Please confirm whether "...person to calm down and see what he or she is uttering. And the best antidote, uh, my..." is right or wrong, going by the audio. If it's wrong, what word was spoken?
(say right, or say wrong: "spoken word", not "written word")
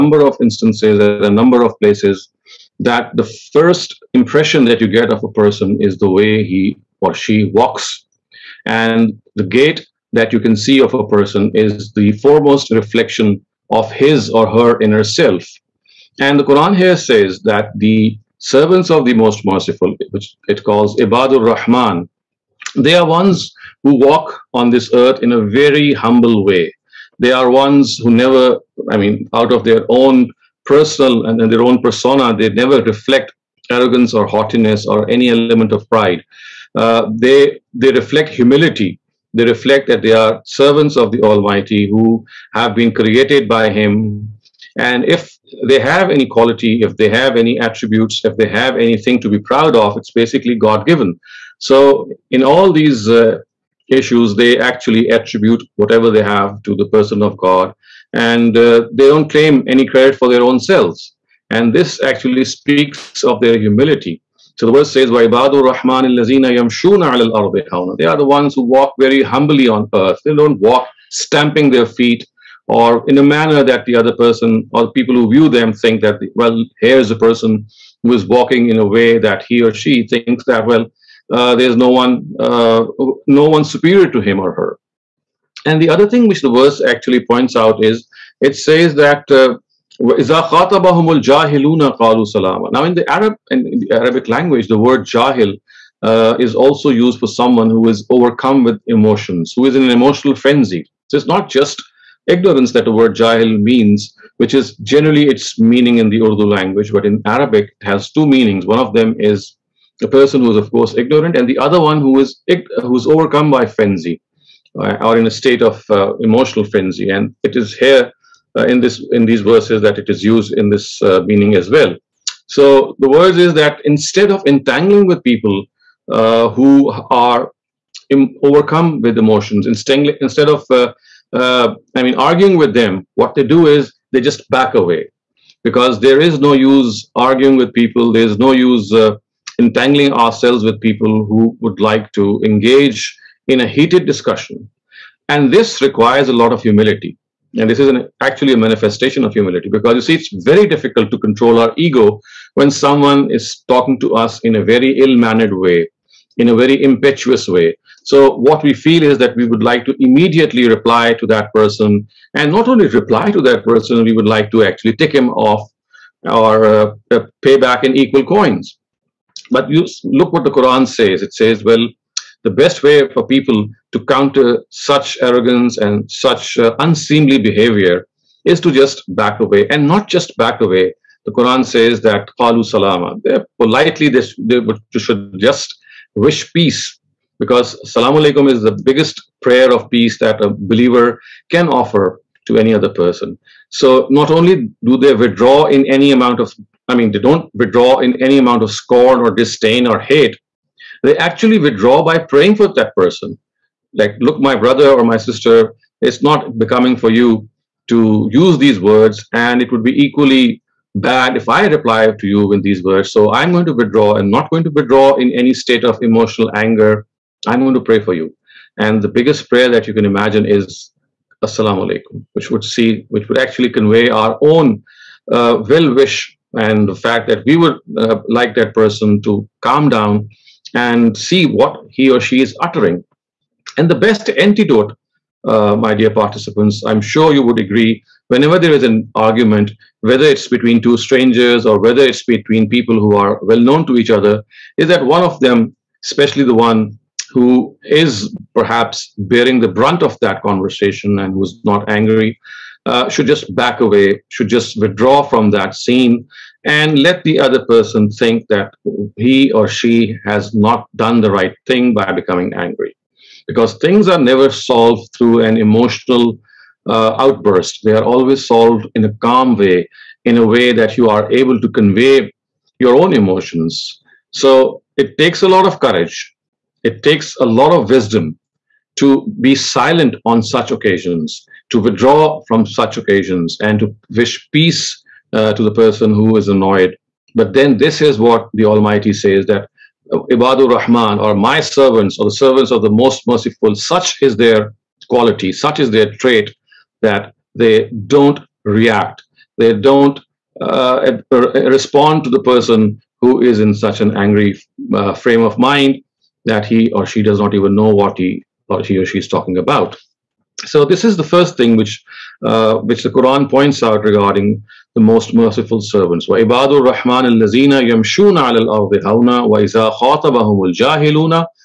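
right.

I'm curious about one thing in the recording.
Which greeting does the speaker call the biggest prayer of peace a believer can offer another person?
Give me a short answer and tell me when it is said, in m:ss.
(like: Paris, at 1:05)
Salamu alaikum, at 3:07.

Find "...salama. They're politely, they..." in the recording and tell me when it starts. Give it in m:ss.
3:02.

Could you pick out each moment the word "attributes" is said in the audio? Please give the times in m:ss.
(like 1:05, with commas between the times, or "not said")
0:47, 0:55.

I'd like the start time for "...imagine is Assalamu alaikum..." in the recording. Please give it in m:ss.
3:40.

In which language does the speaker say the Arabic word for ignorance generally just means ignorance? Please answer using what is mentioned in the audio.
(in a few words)
Urdu.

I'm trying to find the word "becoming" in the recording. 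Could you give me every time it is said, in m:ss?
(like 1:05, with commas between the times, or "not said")
3:26, 4:22.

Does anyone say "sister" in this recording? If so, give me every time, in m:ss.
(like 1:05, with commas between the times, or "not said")
3:25.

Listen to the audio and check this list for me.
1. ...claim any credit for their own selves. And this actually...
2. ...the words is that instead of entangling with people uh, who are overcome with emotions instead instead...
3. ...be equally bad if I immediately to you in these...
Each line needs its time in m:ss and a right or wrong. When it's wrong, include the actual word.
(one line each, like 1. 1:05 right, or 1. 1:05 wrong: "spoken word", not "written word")
1. 0:59 right
2. 2:02 right
3. 3:29 wrong: "reply", not "immediately".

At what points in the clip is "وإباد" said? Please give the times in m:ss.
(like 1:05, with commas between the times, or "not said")
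5:16.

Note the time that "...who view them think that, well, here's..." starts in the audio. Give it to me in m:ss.
1:15.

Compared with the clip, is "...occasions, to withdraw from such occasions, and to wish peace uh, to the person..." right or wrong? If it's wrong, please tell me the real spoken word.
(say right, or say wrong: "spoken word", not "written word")
right.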